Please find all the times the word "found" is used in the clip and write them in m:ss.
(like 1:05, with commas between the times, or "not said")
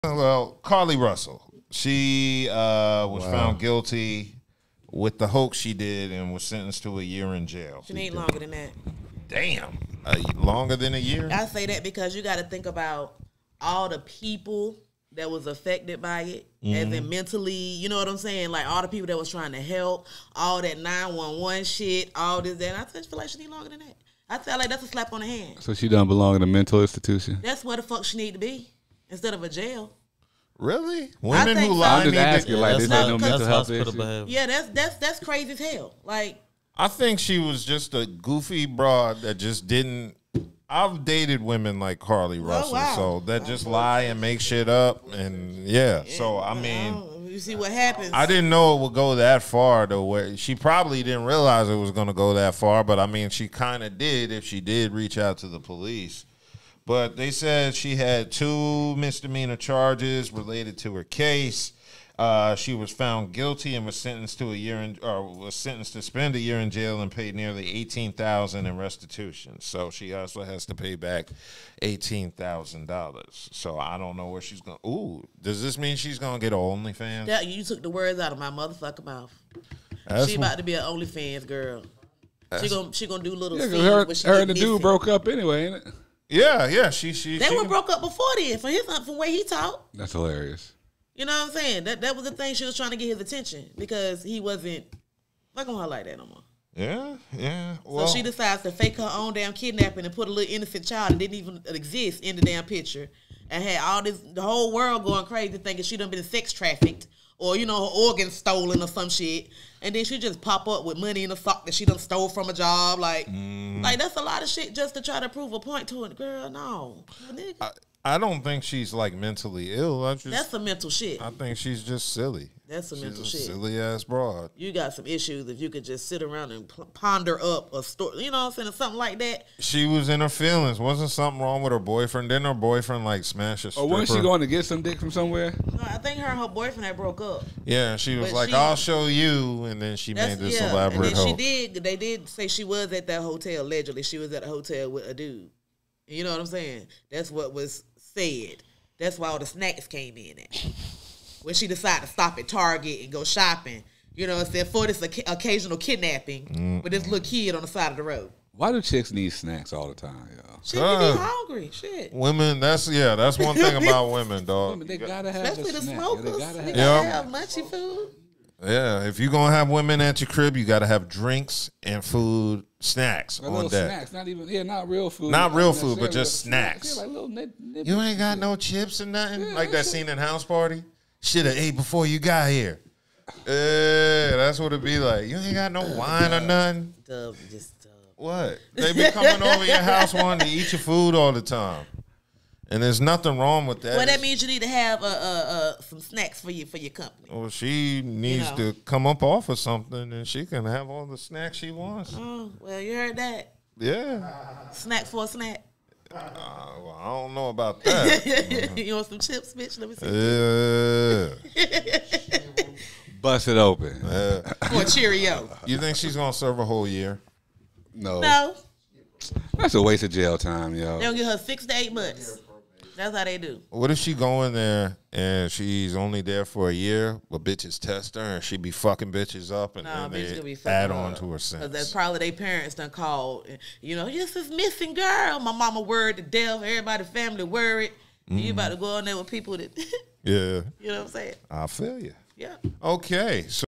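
0:03, 1:02.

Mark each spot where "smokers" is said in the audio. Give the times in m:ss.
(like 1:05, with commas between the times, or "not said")
2:45.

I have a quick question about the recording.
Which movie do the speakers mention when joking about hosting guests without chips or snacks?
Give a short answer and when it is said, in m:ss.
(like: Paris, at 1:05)
House Party, at 3:00.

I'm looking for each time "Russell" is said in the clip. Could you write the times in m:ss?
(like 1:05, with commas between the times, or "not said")
0:00, 0:42.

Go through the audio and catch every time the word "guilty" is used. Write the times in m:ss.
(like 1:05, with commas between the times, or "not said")
0:03, 1:03.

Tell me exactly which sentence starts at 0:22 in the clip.
And I just feel like she need longer than that.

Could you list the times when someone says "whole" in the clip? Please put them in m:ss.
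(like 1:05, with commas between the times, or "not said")
1:44, 3:36.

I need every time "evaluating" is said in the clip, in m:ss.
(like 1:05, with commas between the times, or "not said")
not said.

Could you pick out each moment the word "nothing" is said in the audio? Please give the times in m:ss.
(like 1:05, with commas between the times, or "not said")
2:59, 3:06, 3:13.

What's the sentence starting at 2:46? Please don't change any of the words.
Yeah, they gotta have, they gotta yep.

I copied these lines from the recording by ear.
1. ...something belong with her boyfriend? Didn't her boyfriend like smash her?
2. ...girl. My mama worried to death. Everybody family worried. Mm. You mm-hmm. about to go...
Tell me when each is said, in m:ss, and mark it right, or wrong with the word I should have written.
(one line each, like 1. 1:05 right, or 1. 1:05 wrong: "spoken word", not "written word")
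1. 2:11 wrong: "wrong", not "belong"
2. 3:54 right.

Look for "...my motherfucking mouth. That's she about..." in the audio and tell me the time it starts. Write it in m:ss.
1:18.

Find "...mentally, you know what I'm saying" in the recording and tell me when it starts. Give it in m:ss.
0:17.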